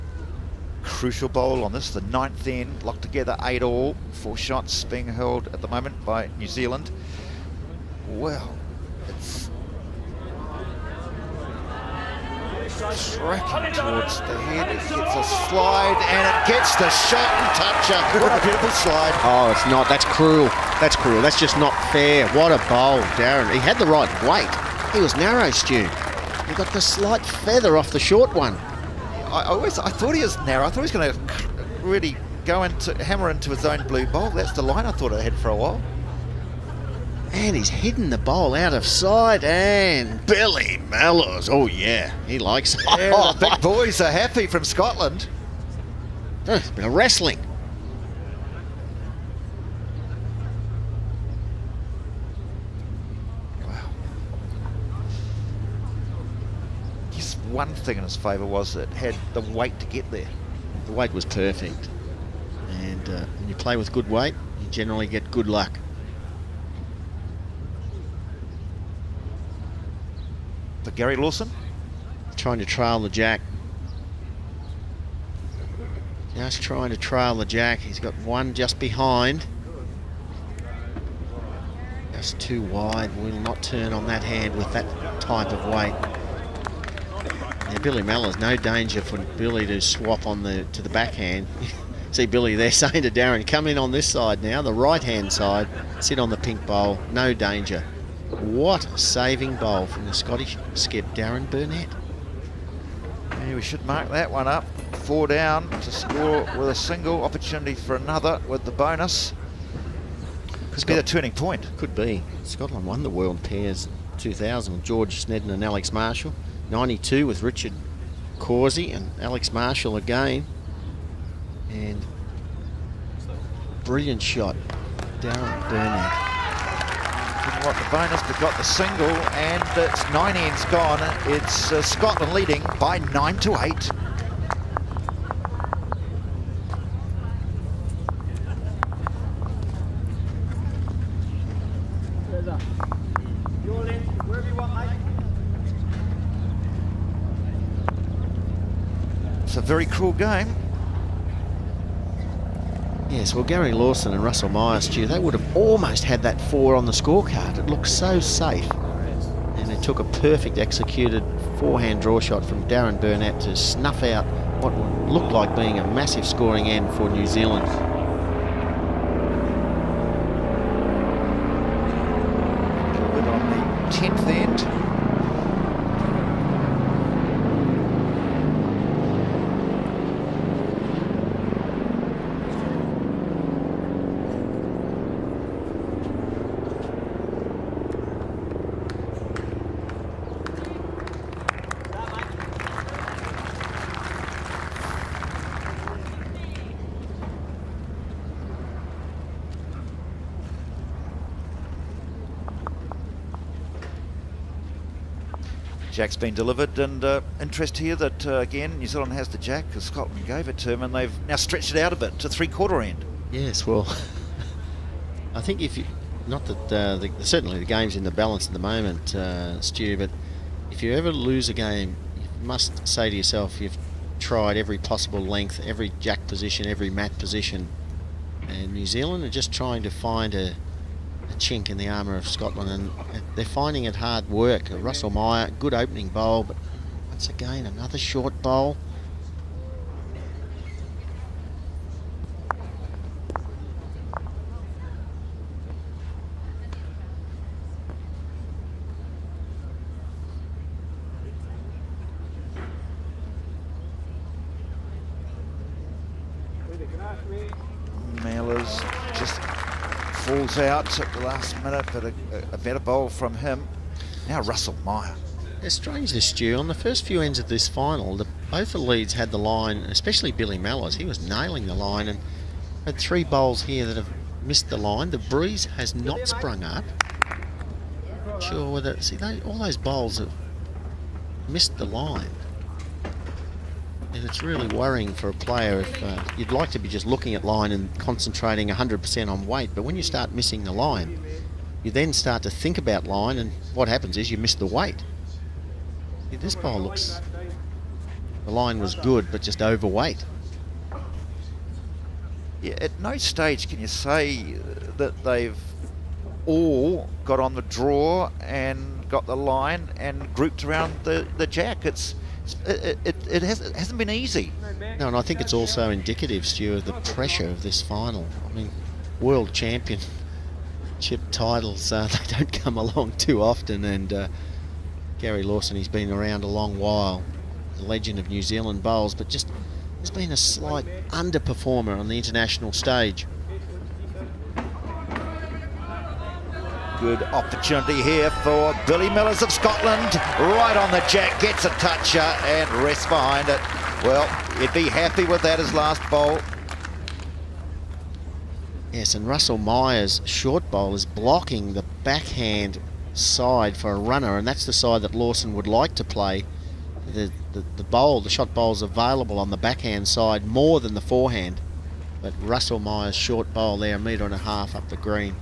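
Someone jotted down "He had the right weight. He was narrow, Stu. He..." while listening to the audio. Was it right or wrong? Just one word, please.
right.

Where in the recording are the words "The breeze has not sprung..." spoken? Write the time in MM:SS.
04:35.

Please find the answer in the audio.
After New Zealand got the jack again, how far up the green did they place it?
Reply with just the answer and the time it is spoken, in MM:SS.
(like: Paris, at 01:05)
three quarter end, at 03:32.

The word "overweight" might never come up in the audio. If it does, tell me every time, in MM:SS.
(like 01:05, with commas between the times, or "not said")
04:59.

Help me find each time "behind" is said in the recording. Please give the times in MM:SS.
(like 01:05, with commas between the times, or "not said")
01:18, 05:43.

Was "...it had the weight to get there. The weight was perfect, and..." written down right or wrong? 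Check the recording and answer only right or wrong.
right.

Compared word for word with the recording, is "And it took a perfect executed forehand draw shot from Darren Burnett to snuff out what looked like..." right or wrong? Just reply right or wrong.
right.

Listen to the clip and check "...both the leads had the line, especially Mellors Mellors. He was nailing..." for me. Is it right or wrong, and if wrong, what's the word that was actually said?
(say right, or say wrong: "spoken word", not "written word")
wrong: "Billy", not "Mellors".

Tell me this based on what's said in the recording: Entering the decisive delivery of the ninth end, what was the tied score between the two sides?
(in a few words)
8 all.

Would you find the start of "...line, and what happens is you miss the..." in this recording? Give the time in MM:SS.
04:53.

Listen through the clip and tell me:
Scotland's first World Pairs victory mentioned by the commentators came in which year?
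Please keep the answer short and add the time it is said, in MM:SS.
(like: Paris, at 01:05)
2000, at 01:54.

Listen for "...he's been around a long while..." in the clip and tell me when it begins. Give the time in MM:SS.
05:25.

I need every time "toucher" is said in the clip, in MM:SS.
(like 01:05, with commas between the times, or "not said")
00:17, 05:41.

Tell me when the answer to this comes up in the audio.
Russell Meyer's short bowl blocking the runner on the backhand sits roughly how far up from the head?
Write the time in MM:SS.
06:03.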